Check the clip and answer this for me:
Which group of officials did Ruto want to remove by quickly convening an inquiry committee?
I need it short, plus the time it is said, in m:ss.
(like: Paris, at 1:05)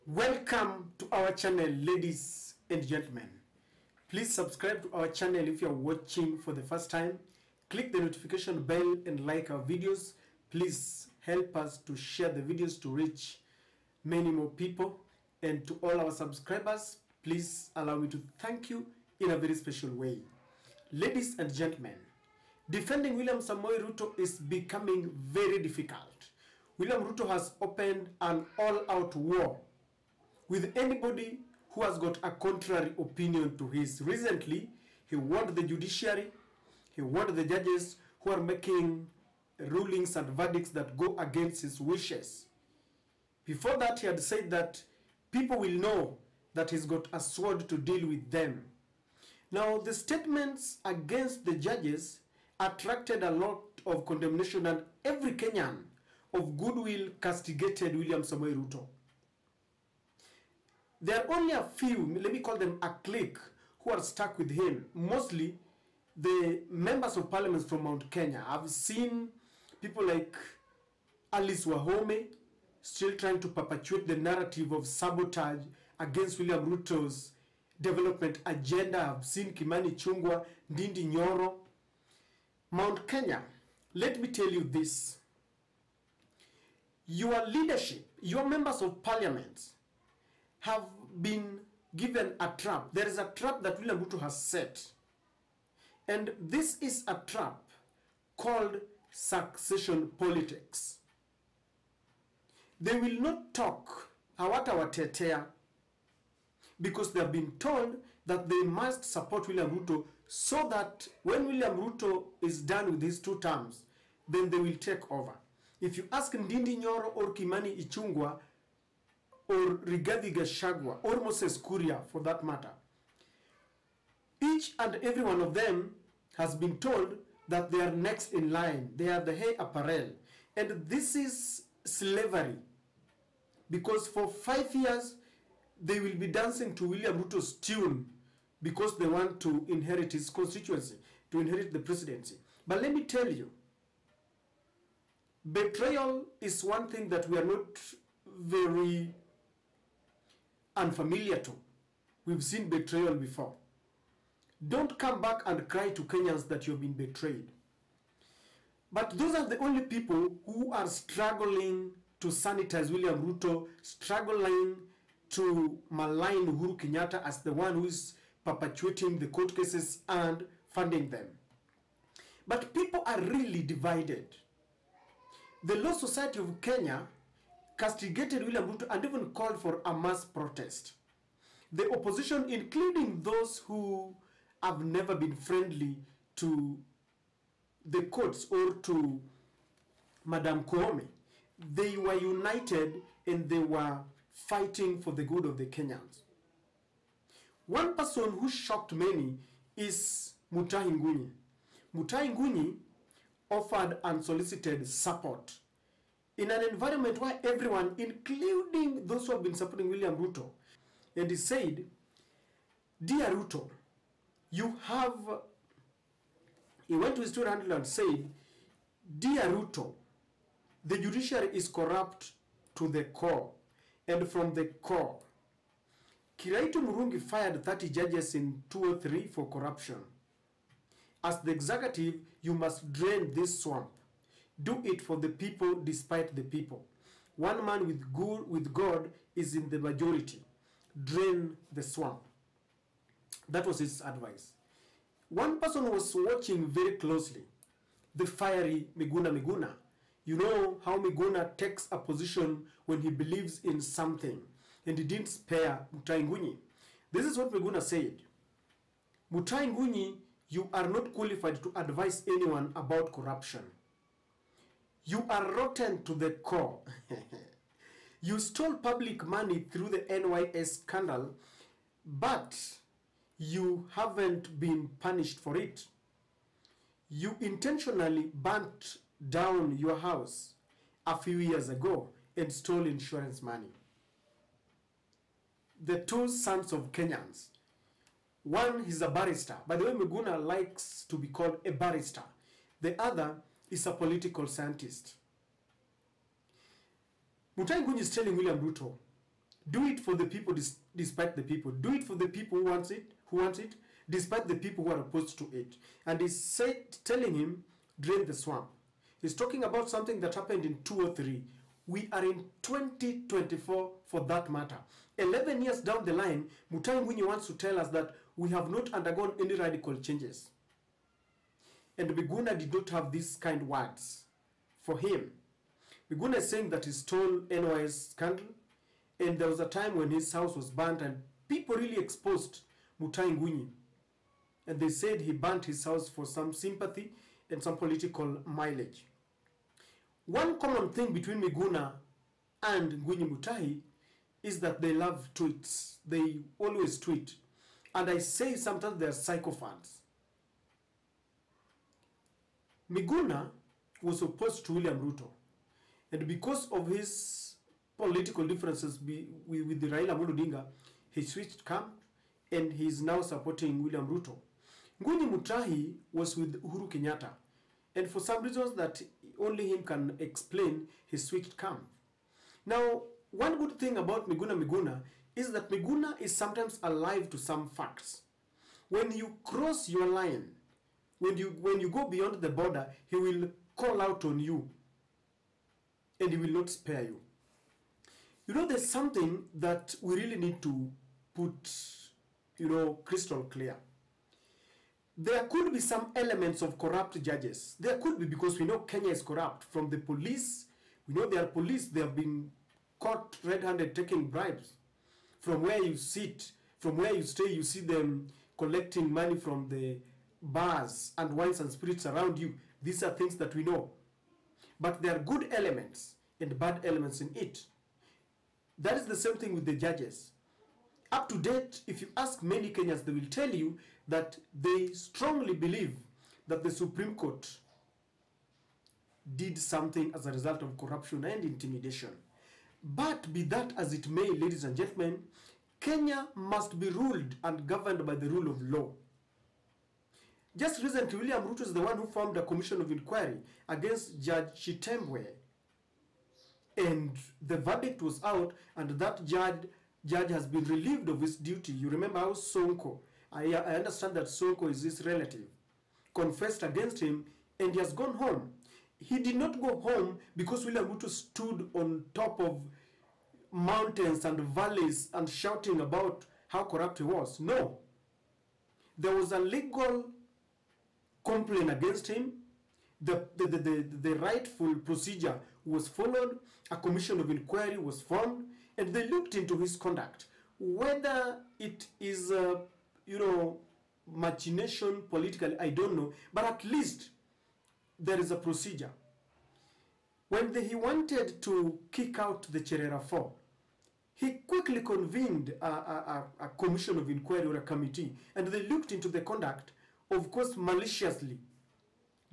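Cherera 4, at 8:12.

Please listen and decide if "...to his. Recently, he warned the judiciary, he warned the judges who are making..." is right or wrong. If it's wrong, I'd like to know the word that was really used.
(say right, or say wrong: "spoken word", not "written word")
right.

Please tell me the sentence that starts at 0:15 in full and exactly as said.
And to all our subscribers, please allow me to thank you in a very special way.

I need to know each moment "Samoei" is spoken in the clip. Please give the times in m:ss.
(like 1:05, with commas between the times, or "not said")
0:23, 0:58.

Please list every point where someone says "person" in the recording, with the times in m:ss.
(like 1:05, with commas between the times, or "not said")
3:17, 4:05.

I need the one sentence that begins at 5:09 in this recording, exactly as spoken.
He's talking about something that happened in 203.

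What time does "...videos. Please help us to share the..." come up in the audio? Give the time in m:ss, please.
0:09.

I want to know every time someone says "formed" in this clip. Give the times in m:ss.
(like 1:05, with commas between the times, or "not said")
7:22, 7:58.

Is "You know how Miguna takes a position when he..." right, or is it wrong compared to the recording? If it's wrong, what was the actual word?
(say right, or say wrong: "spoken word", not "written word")
right.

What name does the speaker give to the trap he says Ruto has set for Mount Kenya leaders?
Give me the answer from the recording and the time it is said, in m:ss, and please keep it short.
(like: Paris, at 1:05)
succession politics, at 1:39.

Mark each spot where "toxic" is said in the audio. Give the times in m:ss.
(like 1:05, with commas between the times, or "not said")
not said.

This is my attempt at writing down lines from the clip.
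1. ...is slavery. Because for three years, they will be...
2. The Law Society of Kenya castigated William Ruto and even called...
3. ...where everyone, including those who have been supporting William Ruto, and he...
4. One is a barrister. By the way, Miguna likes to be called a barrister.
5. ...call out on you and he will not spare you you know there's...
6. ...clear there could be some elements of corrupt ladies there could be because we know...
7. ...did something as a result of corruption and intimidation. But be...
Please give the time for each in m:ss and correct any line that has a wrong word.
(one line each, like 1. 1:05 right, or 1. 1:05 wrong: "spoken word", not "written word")
1. 2:11 wrong: "five", not "three"
2. 2:55 right
3. 3:27 right
4. 4:48 right
5. 6:23 right
6. 6:33 wrong: "judges", not "ladies"
7. 7:09 right.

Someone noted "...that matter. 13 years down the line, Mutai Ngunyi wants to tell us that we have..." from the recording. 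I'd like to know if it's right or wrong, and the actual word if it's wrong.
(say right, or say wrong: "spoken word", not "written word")
wrong: "11", not "13".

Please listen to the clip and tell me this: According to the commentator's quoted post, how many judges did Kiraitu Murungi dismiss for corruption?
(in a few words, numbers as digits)
30.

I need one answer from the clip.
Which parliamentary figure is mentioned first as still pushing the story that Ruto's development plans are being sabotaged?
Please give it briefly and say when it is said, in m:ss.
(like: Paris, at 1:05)
Alice Wahome, at 1:11.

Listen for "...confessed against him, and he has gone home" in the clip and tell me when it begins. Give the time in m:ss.
7:36.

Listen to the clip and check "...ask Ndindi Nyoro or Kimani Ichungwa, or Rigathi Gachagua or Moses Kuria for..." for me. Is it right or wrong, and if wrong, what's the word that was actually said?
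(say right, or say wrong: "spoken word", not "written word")
right.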